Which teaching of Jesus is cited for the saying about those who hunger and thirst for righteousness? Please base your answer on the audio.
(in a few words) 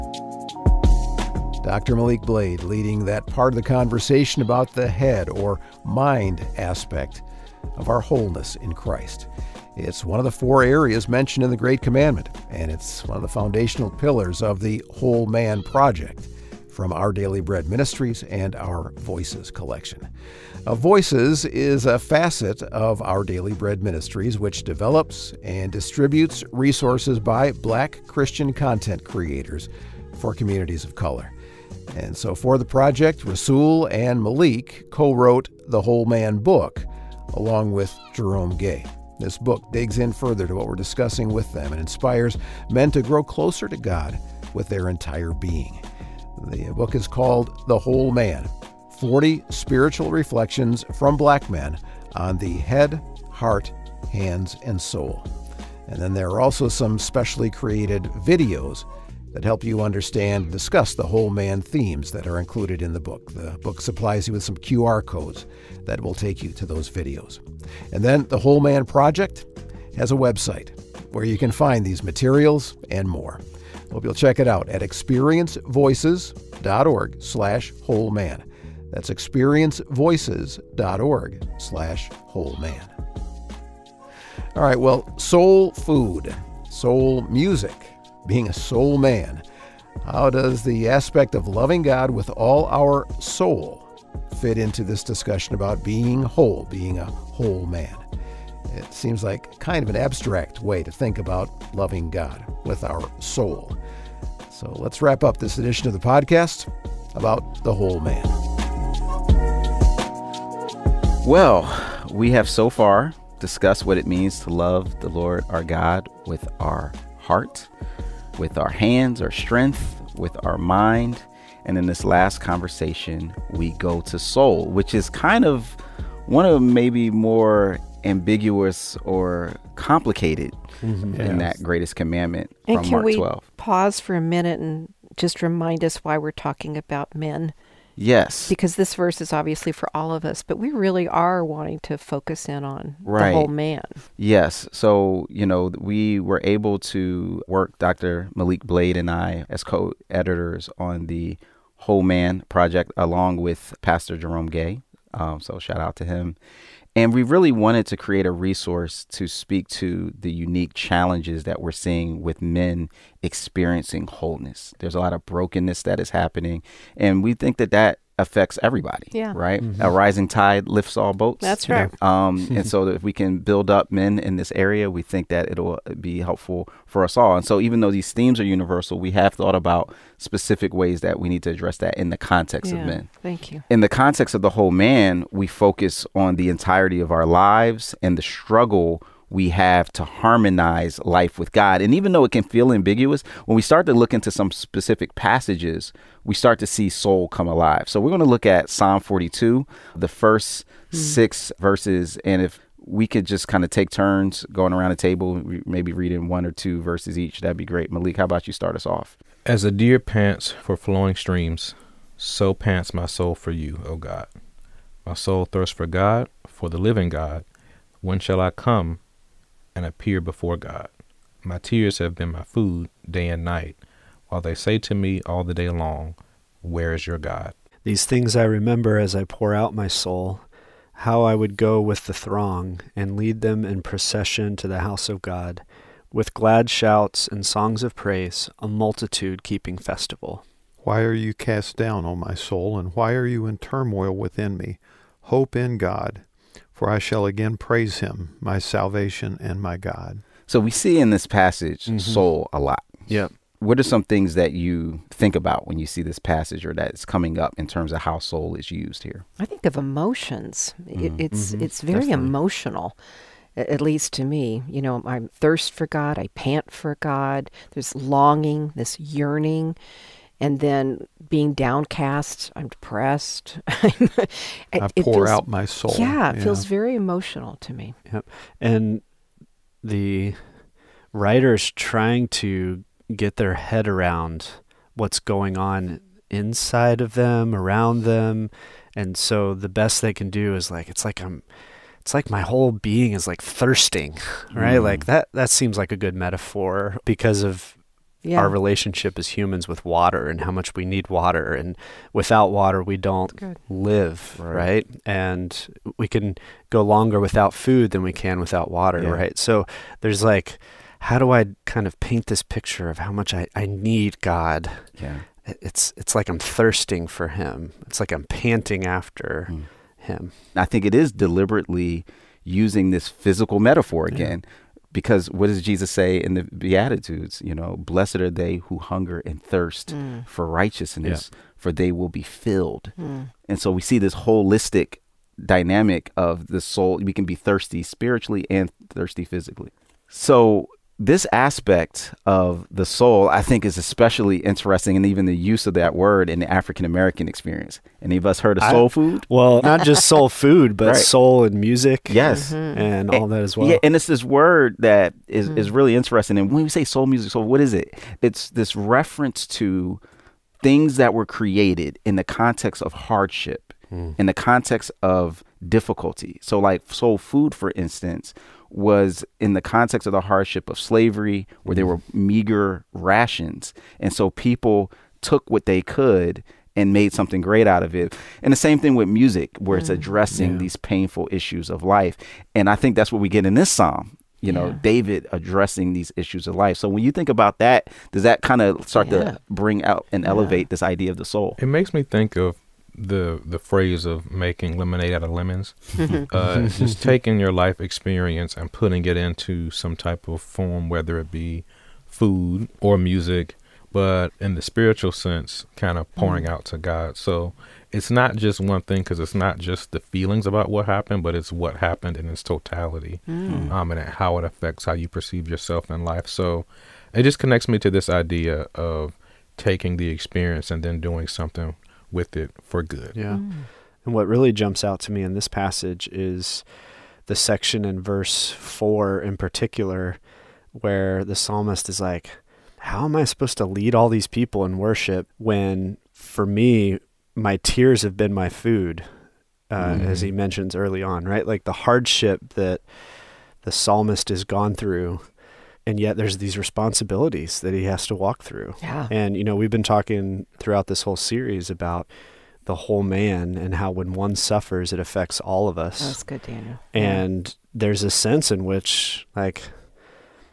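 The Beatitudes.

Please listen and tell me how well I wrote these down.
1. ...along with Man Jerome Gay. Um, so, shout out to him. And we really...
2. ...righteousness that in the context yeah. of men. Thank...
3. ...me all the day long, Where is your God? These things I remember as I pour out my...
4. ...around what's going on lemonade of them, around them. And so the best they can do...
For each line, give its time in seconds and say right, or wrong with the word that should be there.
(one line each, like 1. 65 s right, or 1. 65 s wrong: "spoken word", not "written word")
1. 152 s wrong: "Pastor", not "Man"
2. 181 s wrong: "address", not "righteousness"
3. 224 s right
4. 283 s wrong: "inside", not "lemonade".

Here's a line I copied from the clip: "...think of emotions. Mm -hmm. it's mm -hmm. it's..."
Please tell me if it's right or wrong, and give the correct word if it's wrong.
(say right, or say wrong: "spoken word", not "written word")
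right.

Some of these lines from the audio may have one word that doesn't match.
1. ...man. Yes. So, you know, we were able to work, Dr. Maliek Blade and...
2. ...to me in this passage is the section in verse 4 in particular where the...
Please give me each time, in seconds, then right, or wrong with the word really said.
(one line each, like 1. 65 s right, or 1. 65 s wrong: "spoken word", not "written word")
1. 143 s right
2. 425 s right.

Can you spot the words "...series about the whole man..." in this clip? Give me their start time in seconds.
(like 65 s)
451 s.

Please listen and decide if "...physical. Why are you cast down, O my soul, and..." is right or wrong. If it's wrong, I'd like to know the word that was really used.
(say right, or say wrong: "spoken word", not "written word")
wrong: "festival", not "physical".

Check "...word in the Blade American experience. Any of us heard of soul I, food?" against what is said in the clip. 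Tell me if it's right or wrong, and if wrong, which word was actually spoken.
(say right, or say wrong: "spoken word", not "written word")
wrong: "African", not "Blade".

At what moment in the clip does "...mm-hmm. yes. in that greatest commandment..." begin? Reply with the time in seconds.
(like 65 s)
130 s.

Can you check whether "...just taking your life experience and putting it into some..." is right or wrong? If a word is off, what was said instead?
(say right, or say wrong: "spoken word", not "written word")
right.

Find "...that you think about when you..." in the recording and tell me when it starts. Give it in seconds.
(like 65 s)
254 s.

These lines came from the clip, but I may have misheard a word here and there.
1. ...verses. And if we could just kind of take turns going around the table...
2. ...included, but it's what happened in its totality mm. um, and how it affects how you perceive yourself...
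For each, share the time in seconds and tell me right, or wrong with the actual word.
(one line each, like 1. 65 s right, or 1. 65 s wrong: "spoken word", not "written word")
1. 201 s right
2. 410 s wrong: "happened", not "included".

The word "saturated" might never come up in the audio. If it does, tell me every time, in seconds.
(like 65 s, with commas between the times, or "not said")
not said.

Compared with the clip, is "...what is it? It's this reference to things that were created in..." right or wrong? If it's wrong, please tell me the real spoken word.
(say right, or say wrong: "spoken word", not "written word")
right.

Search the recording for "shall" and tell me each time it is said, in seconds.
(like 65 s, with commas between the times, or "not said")
218 s, 246 s.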